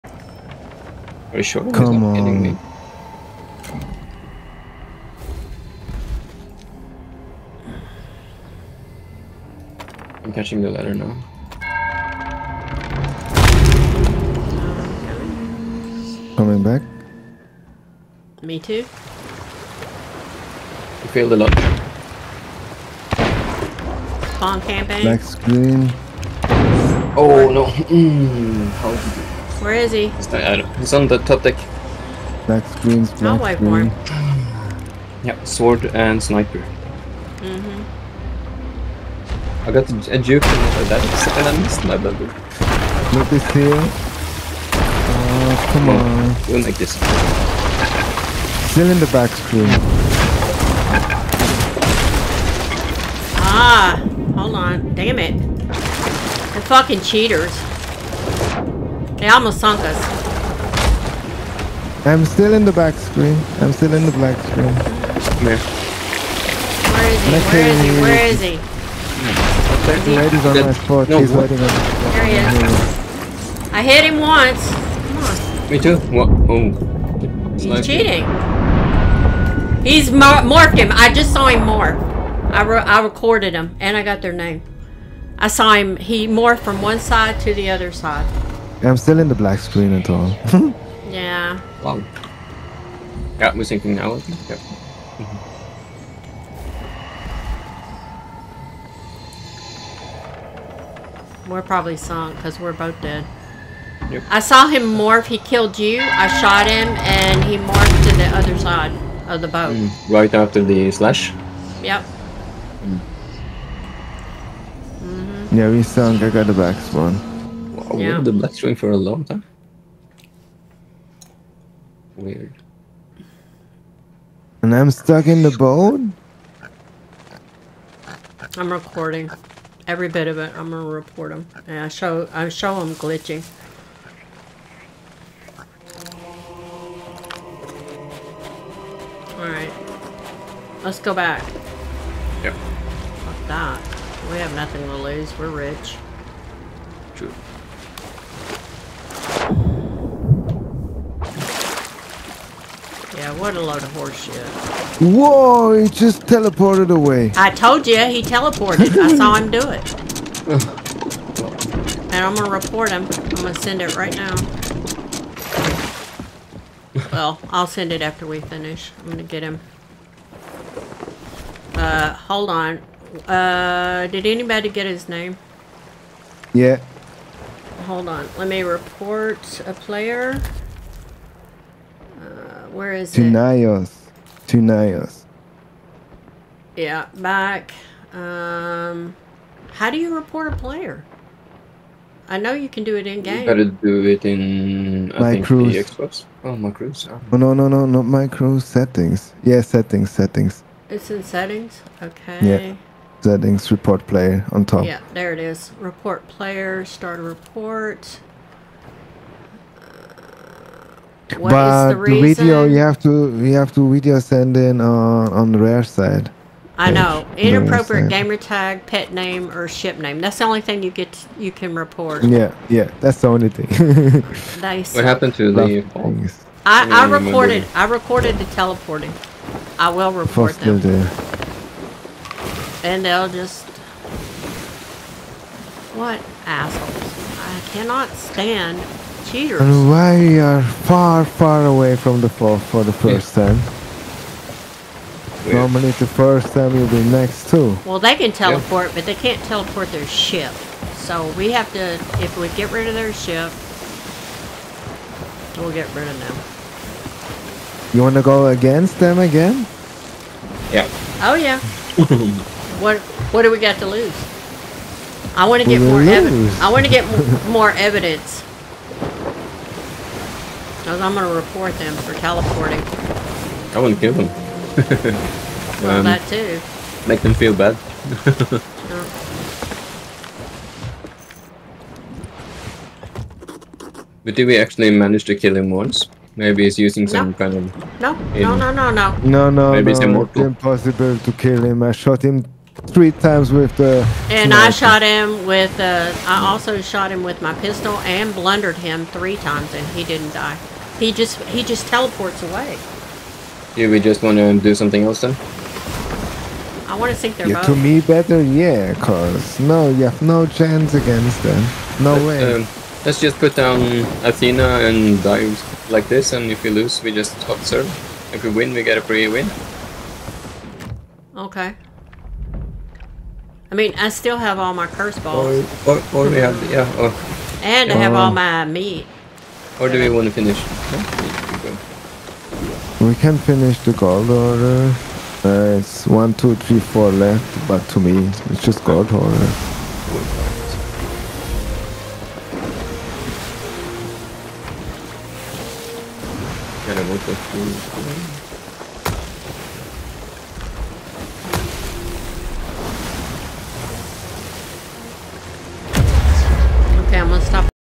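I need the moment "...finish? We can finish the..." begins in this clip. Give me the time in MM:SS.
05:30.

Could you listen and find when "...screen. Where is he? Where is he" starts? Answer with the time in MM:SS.
01:04.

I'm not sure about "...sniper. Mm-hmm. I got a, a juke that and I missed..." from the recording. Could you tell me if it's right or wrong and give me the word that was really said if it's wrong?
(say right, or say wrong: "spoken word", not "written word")
right.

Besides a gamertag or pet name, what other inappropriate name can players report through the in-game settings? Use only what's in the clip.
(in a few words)
ship name.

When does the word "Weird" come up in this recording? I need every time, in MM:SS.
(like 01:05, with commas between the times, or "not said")
02:02, 04:05.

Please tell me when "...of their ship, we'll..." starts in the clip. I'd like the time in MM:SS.
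04:12.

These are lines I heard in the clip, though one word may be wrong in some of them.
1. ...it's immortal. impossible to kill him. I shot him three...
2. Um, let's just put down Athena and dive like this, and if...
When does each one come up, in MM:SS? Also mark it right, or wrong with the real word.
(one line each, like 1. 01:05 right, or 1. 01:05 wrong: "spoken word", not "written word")
1. 04:49 right
2. 05:12 right.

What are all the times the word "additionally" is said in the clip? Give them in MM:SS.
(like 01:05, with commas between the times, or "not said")
not said.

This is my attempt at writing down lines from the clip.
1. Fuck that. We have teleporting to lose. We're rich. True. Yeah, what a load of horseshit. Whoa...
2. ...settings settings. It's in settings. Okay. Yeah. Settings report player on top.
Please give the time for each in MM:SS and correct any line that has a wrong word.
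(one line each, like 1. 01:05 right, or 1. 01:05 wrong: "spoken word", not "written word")
1. 02:22 wrong: "nothing", not "teleporting"
2. 03:19 right.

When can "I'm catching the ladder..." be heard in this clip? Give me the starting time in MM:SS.
00:10.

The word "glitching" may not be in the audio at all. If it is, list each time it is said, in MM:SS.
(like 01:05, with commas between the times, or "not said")
02:12.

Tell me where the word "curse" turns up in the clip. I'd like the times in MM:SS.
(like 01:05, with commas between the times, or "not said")
05:24.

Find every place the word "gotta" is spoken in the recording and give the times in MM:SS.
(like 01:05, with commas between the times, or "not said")
03:13, 05:48.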